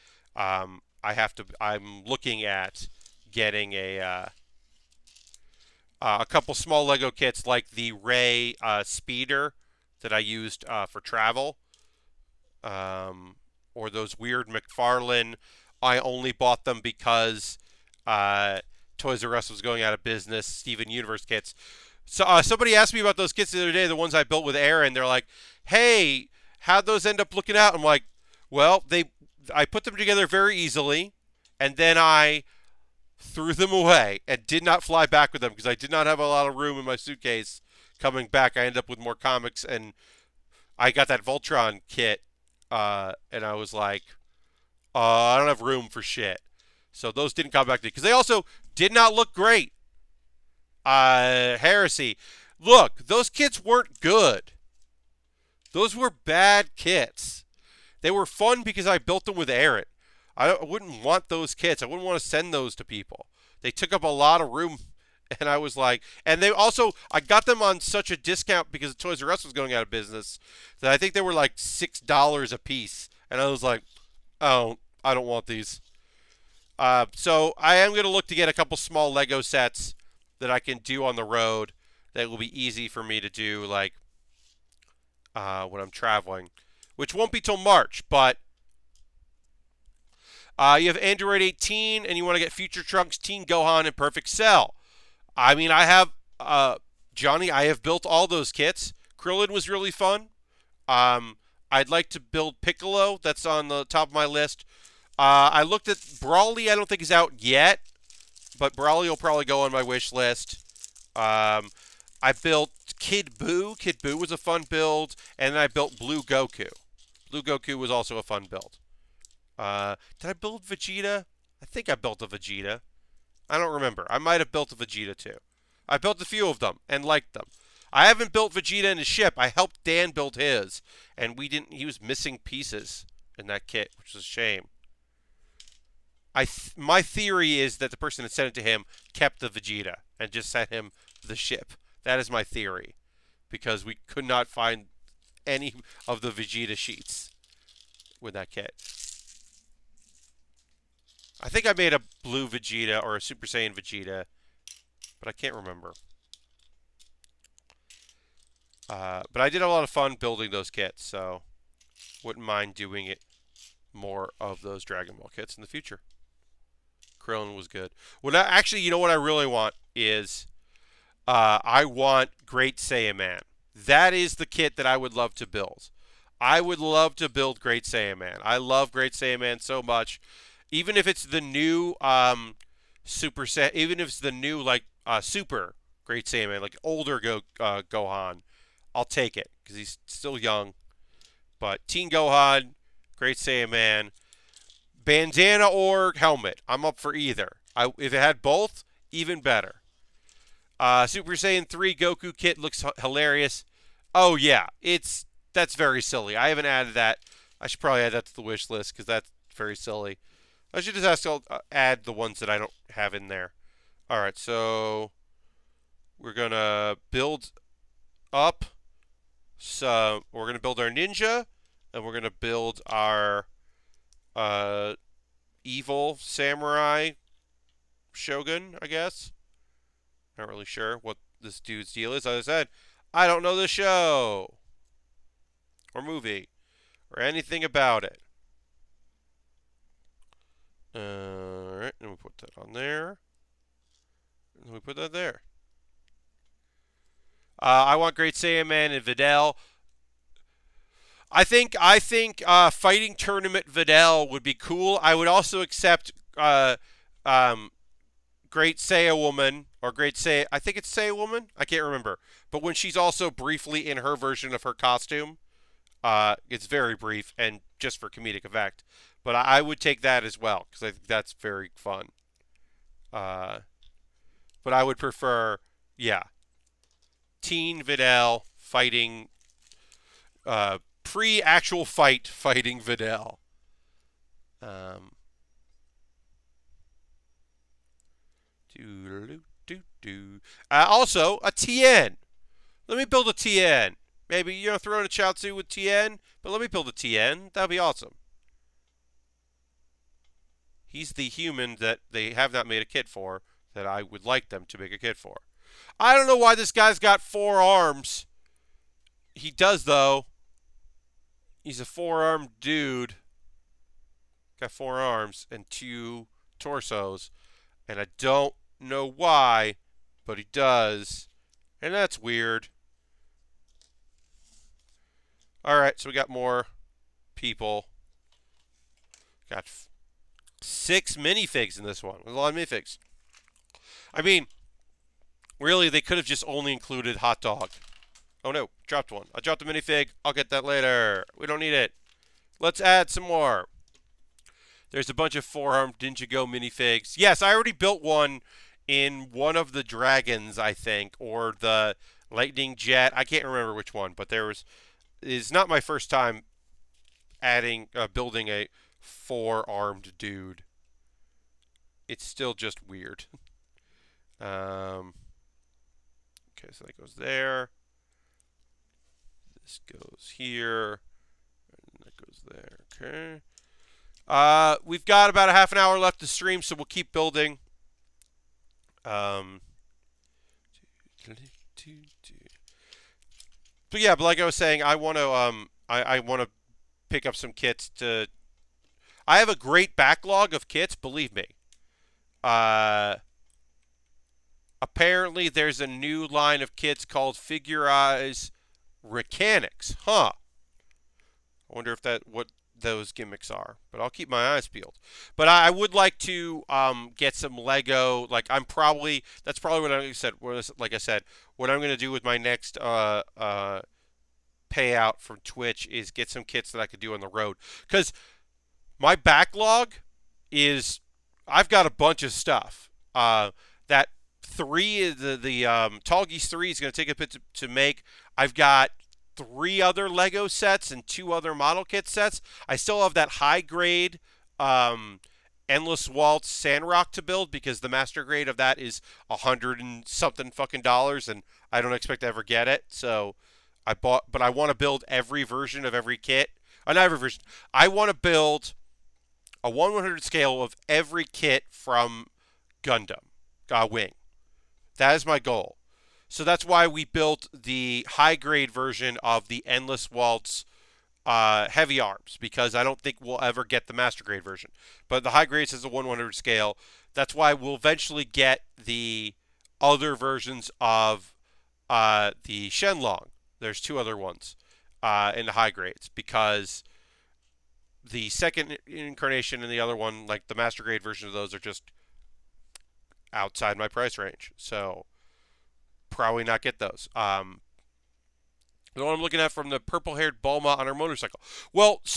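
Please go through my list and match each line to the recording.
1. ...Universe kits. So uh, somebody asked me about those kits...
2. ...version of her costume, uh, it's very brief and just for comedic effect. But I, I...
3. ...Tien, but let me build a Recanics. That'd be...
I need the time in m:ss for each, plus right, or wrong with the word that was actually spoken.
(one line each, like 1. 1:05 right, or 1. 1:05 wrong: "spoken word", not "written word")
1. 0:20 right
2. 4:24 right
3. 4:55 wrong: "Tien", not "Recanics".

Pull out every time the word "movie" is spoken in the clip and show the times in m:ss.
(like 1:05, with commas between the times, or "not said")
3:56.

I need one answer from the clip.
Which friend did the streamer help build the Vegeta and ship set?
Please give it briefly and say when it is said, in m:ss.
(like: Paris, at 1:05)
Dan, at 2:09.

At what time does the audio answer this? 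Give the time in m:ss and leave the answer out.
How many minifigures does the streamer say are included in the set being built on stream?
5:30.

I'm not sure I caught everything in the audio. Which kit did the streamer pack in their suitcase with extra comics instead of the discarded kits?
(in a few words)
Voltron kit.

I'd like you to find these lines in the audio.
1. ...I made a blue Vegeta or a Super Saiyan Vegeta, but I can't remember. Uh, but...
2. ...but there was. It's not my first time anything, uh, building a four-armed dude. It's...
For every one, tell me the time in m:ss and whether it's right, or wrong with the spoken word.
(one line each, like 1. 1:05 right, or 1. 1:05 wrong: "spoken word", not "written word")
1. 2:31 right
2. 5:54 wrong: "adding", not "anything".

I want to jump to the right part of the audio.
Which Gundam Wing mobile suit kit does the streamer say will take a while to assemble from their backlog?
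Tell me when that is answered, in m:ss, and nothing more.
7:06.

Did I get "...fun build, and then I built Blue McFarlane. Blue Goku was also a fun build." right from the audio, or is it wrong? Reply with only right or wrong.
wrong.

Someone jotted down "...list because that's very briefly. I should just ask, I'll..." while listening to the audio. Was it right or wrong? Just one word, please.
wrong.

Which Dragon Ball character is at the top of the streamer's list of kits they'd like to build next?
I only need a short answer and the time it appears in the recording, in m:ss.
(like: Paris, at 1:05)
Piccolo, at 1:42.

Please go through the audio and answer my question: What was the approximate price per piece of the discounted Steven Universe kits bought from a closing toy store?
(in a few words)
$6.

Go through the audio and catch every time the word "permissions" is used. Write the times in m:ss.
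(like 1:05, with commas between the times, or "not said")
not said.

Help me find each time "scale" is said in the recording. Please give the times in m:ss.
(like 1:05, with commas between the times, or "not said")
7:30, 7:46.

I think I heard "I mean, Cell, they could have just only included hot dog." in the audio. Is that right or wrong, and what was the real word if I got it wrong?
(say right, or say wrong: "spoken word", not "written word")
wrong: "Really", not "Cell".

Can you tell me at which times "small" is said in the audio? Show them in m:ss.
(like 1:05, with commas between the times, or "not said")
0:06, 1:18.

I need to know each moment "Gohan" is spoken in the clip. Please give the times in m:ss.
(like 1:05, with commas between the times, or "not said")
1:33, 3:07, 3:12.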